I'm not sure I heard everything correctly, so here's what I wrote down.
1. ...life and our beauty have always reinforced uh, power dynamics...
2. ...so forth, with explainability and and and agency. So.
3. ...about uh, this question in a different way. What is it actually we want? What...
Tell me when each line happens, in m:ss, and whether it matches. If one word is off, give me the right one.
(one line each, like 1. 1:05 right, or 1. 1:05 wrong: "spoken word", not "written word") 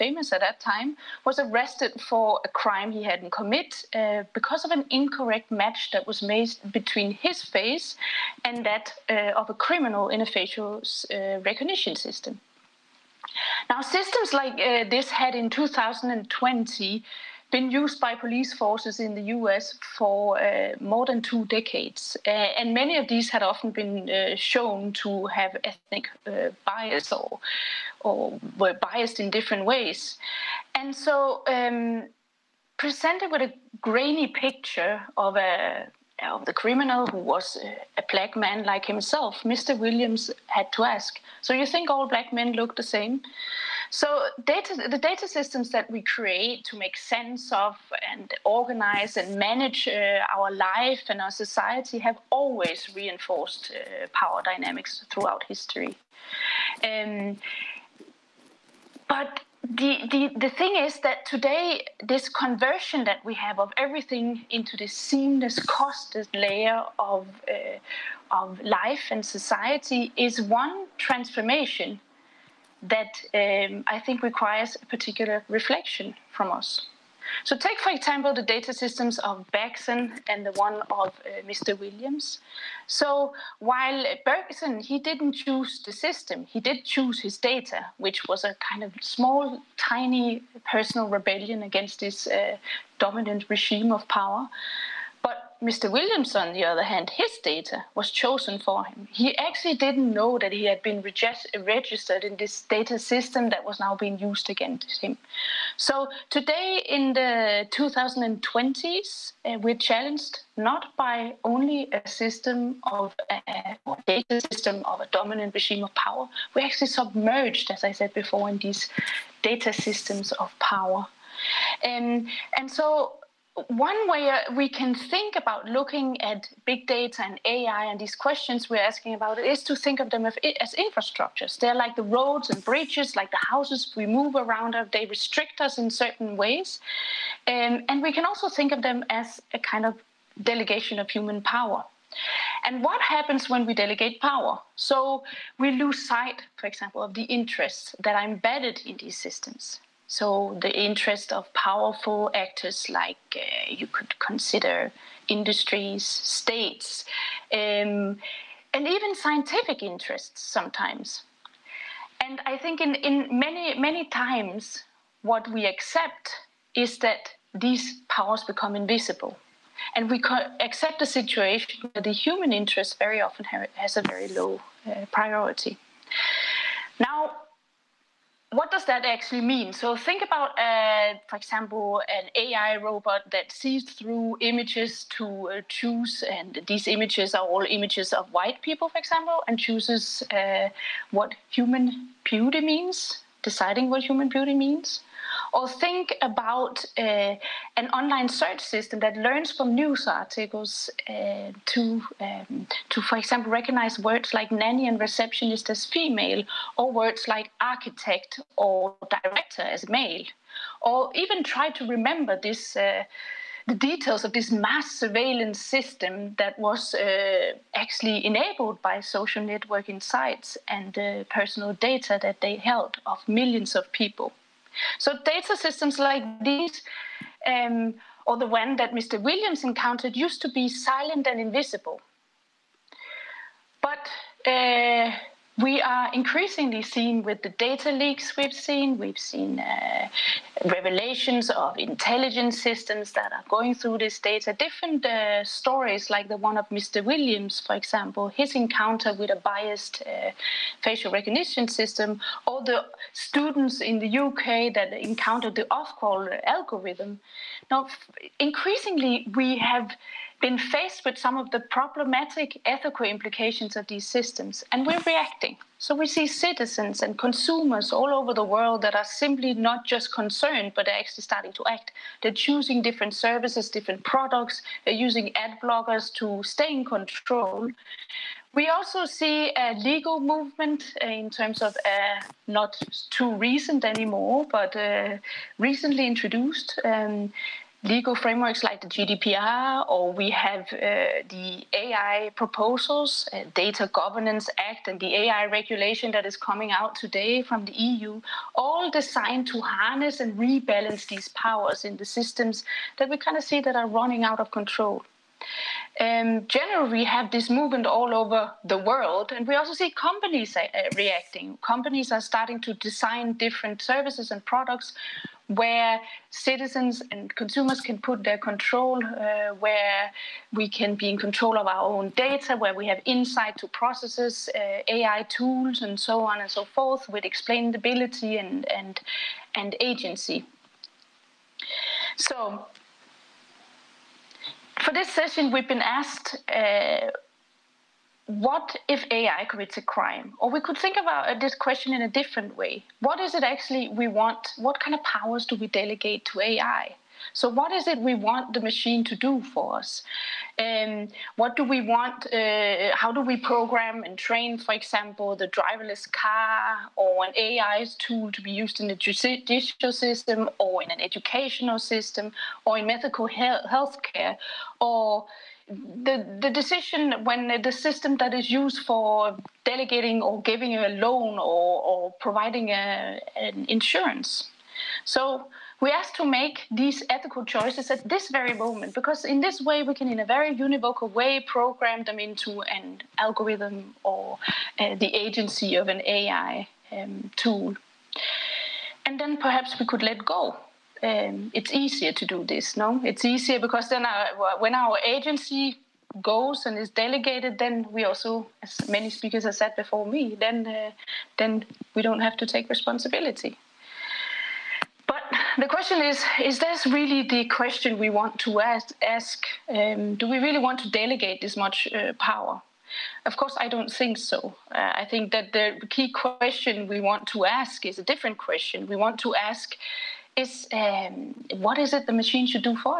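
1. 0:50 wrong: "society", not "beauty"
2. 5:26 right
3. 5:41 right.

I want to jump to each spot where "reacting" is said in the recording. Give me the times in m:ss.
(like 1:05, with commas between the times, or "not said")
4:25, 5:10.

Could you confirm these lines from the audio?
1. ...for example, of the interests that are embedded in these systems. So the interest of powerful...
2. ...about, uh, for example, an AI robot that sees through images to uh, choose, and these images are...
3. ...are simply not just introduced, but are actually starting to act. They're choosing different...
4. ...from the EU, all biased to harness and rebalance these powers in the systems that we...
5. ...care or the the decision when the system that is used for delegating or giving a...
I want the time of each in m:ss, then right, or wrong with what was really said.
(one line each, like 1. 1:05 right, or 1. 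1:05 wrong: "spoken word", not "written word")
1. 2:26 right
2. 3:00 right
3. 4:28 wrong: "concerned", not "introduced"
4. 4:57 wrong: "designed", not "biased"
5. 6:04 right.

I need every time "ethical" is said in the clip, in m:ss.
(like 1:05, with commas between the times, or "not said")
4:22, 6:17.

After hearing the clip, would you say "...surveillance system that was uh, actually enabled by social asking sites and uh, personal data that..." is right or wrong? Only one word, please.
wrong.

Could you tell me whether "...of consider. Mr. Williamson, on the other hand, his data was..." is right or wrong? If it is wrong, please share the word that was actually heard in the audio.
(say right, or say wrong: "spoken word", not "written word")
wrong: "power", not "consider".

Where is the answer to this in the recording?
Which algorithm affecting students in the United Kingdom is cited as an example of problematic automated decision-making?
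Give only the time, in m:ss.
4:15.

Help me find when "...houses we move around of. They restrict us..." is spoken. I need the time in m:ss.
2:13.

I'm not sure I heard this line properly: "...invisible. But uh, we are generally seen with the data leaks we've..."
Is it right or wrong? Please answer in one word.
wrong.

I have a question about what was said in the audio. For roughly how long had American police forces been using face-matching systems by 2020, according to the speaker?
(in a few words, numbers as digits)
more than two decades.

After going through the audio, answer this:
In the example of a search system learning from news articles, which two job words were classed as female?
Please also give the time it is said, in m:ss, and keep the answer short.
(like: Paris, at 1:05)
nanny and receptionist, at 3:24.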